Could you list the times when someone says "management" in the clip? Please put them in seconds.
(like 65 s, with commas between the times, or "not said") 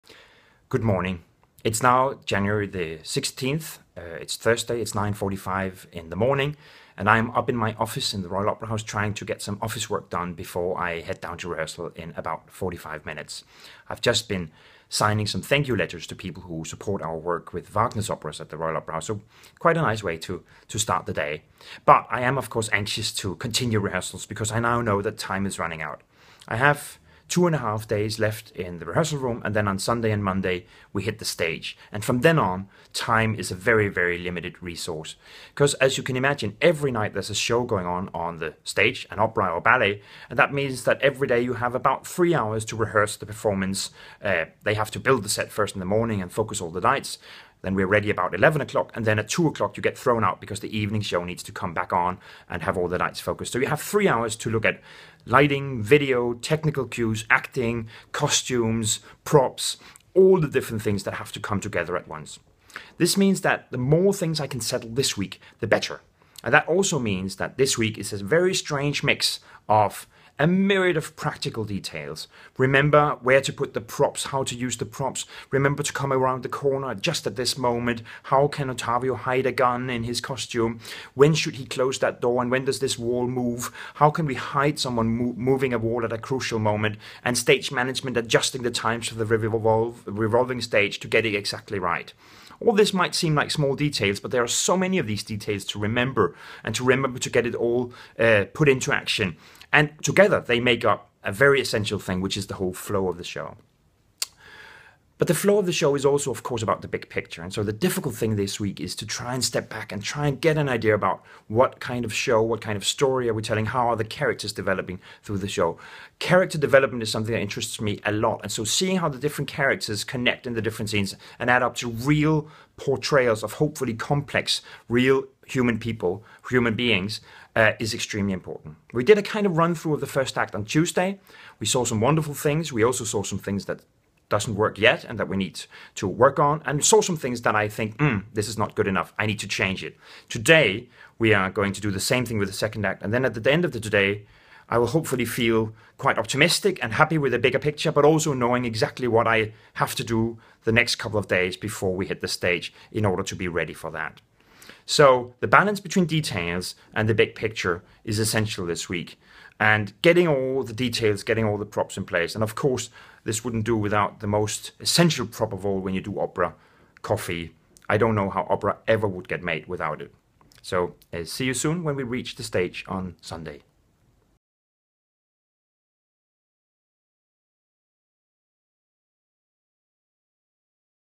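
87 s.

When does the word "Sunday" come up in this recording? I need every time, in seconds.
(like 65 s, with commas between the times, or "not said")
29 s, 173 s.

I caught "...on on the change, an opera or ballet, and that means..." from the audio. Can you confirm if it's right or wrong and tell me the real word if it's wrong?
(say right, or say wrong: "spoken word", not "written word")
wrong: "stage", not "change".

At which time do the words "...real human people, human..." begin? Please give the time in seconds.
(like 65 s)
124 s.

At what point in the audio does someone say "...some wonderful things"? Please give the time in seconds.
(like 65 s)
131 s.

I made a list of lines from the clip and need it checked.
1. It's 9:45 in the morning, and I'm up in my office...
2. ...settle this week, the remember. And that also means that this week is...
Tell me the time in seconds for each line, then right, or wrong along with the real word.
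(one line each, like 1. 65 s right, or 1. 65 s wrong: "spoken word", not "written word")
1. 4 s right
2. 64 s wrong: "better", not "remember".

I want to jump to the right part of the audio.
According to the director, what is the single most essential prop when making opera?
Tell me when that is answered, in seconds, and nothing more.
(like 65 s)
167 s.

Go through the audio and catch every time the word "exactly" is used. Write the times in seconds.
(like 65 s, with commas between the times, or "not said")
91 s, 148 s.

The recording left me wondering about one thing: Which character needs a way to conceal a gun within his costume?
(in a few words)
Ottavio.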